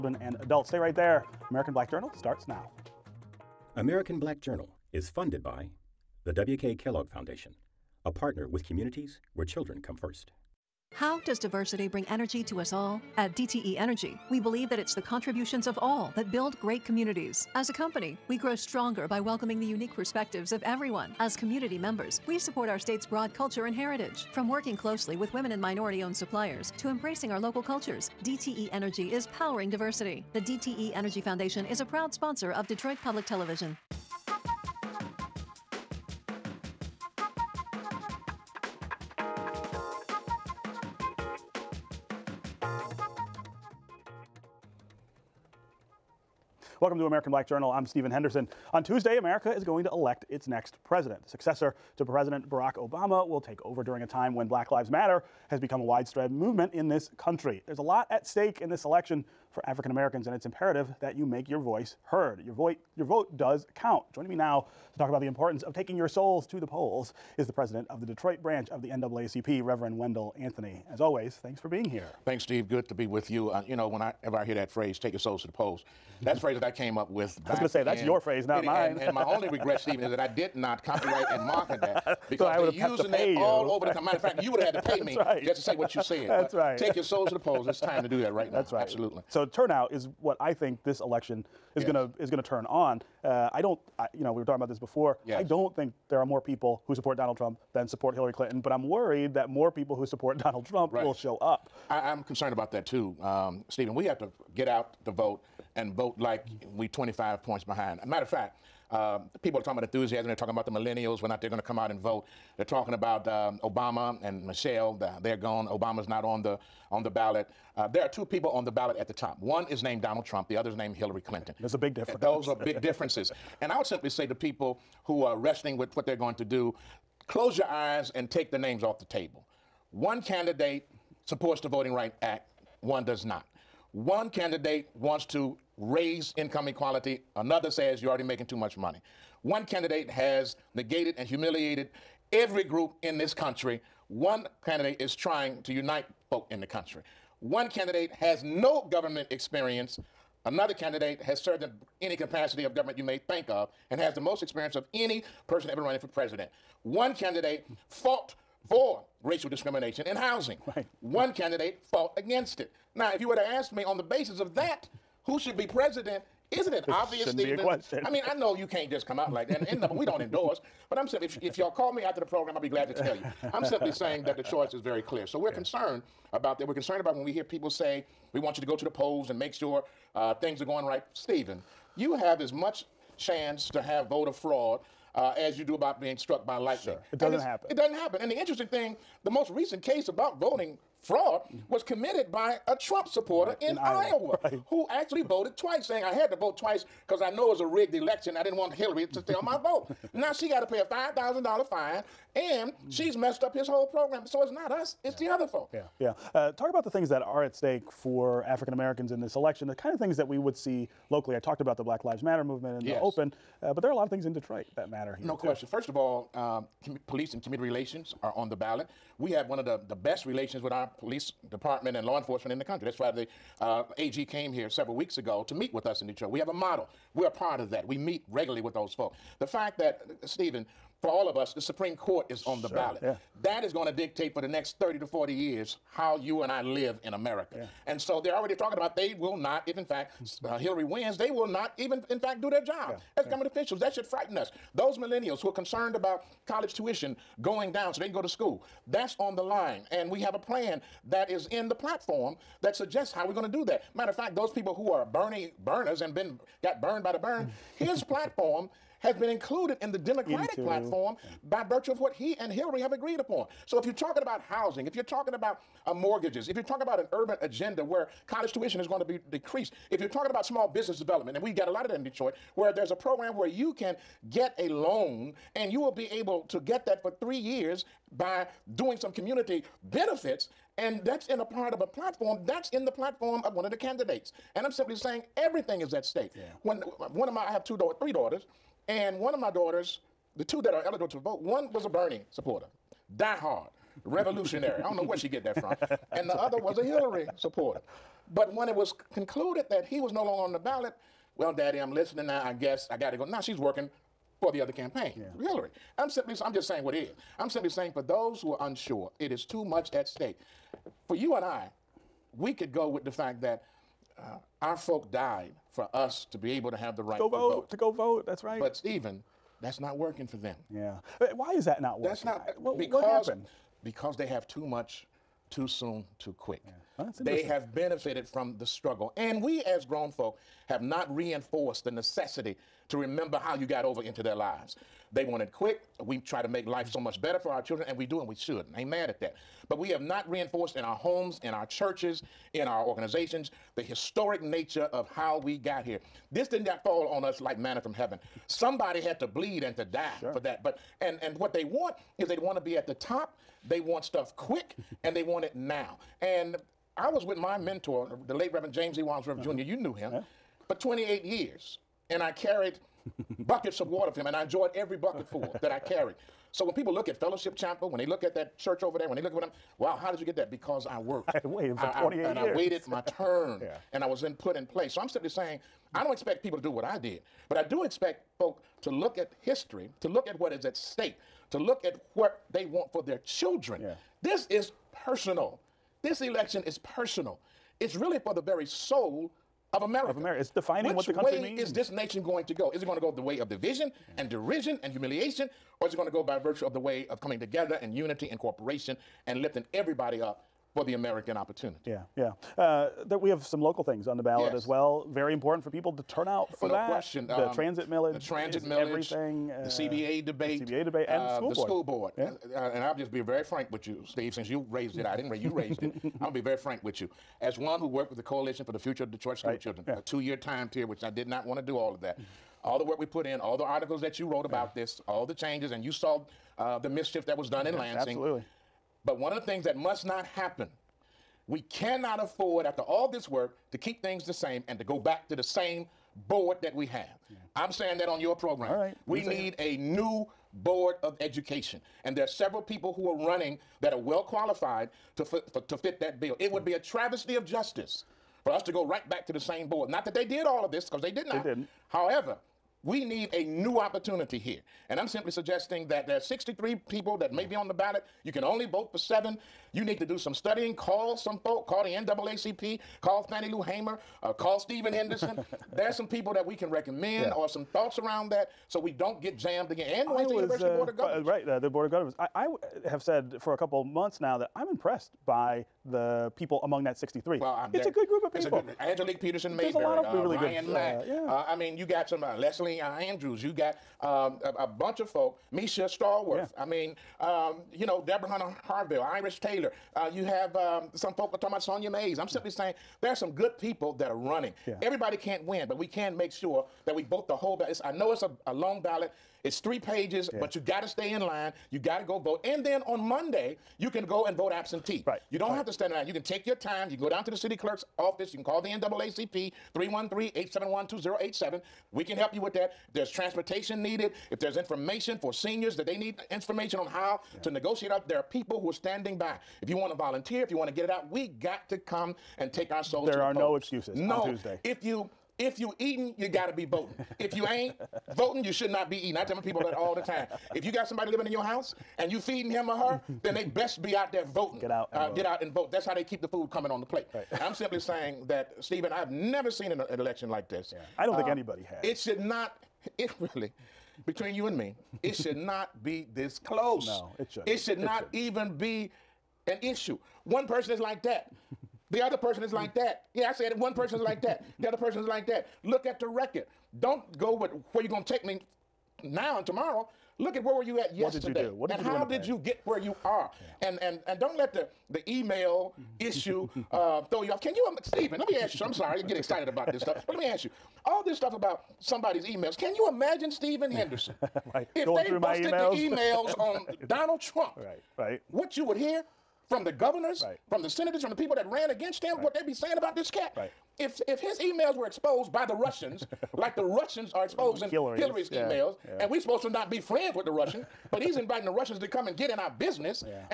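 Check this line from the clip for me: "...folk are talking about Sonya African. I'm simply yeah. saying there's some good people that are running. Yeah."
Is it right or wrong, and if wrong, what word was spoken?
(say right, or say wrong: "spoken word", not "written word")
wrong: "Mays", not "African".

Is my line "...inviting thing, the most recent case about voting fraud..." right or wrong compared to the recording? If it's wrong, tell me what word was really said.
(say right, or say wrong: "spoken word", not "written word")
wrong: "interesting", not "inviting".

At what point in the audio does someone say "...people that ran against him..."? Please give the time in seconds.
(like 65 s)
581 s.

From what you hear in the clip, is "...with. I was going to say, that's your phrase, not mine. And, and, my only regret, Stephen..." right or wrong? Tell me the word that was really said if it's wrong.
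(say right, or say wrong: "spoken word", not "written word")
right.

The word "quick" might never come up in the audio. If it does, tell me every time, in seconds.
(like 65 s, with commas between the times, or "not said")
326 s, 335 s, 354 s.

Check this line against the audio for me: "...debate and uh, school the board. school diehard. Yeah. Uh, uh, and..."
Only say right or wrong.
wrong.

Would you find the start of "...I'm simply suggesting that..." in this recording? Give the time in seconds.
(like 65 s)
454 s.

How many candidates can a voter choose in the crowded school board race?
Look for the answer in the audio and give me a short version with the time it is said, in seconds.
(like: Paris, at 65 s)
7, at 458 s.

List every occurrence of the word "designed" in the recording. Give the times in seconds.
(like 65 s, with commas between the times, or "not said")
not said.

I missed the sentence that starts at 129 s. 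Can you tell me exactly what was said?
One candidate supports the Voting Rights Act, one does not.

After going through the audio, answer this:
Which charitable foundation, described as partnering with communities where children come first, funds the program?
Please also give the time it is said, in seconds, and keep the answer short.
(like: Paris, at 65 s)
W.K. Kellogg Foundation, at 6 s.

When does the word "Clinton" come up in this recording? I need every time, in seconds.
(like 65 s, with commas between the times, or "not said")
98 s, 121 s.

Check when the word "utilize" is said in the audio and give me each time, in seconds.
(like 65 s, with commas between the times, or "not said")
not said.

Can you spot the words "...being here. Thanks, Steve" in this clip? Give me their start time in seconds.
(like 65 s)
71 s.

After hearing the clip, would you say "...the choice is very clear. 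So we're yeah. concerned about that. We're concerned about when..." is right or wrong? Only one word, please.
right.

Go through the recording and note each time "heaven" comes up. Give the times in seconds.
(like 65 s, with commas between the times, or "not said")
347 s.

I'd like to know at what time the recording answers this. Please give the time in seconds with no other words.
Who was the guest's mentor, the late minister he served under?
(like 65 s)
358 s.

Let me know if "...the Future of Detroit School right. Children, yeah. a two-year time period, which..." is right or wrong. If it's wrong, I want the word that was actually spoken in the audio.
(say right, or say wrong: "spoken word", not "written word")
right.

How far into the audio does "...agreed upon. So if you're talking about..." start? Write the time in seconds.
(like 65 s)
262 s.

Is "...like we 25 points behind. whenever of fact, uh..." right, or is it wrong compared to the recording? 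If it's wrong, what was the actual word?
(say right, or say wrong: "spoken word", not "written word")
wrong: "matter", not "whenever".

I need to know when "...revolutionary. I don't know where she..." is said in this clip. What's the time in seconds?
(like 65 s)
294 s.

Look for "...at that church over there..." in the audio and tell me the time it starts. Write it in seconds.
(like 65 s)
368 s.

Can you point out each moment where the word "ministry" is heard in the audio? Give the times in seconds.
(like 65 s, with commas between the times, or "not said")
not said.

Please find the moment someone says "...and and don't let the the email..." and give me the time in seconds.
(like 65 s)
563 s.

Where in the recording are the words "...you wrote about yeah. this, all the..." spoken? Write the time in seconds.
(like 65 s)
424 s.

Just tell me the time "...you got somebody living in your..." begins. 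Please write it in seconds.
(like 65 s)
530 s.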